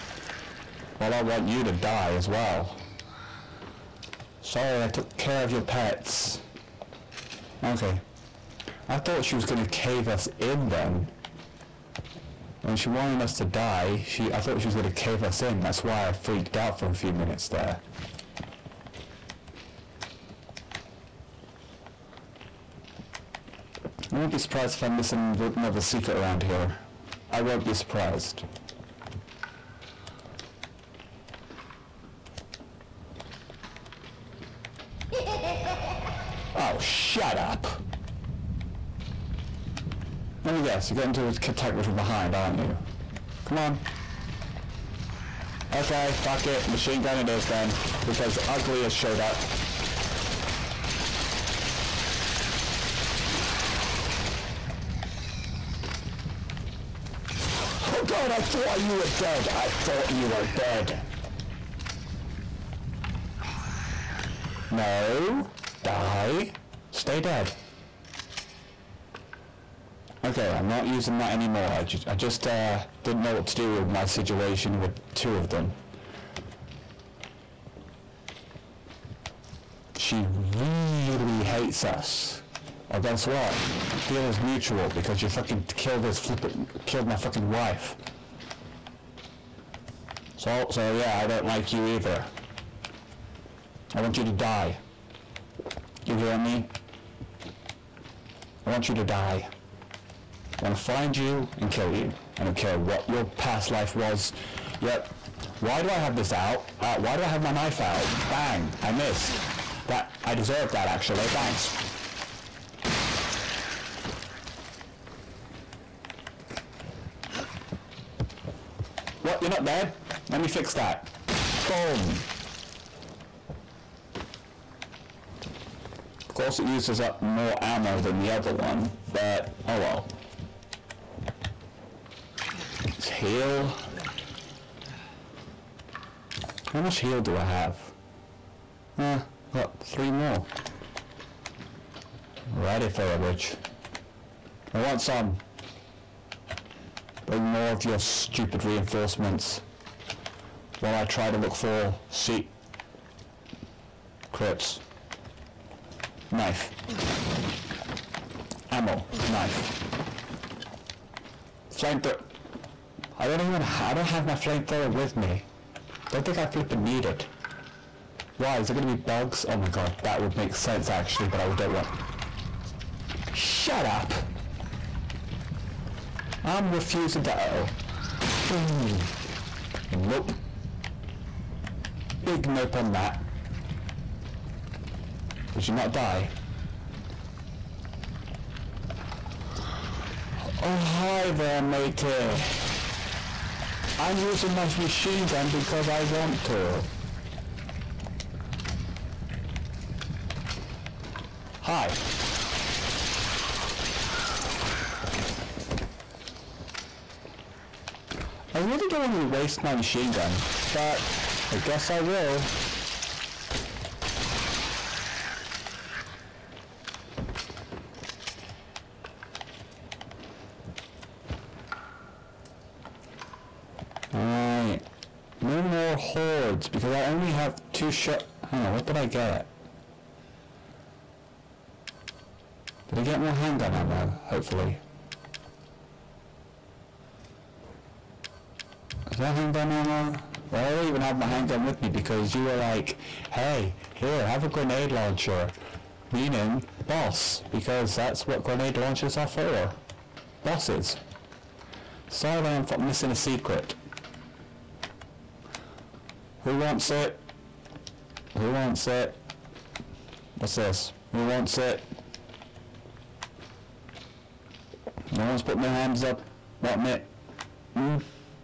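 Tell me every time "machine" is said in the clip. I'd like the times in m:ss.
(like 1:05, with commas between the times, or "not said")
0:46, 3:14, 3:29.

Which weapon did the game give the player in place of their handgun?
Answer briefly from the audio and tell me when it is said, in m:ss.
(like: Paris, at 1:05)
Grenade launcher, at 4:04.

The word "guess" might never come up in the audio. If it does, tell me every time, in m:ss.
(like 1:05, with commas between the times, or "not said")
0:40, 1:23, 3:31.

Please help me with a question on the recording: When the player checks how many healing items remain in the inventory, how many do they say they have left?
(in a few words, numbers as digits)
3.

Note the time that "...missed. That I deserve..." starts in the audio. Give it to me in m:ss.
1:48.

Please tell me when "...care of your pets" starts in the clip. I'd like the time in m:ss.
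0:05.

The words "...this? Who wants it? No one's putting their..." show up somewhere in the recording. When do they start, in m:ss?
4:20.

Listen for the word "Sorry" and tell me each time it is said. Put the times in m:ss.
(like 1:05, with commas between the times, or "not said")
0:04, 4:12.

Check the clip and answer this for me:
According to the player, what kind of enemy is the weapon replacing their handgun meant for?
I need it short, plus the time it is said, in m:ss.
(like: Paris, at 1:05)
Bosses, at 4:10.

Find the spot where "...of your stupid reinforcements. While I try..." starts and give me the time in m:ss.
2:27.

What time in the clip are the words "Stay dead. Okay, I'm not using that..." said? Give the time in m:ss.
1:06.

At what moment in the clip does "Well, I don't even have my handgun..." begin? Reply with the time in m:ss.
4:00.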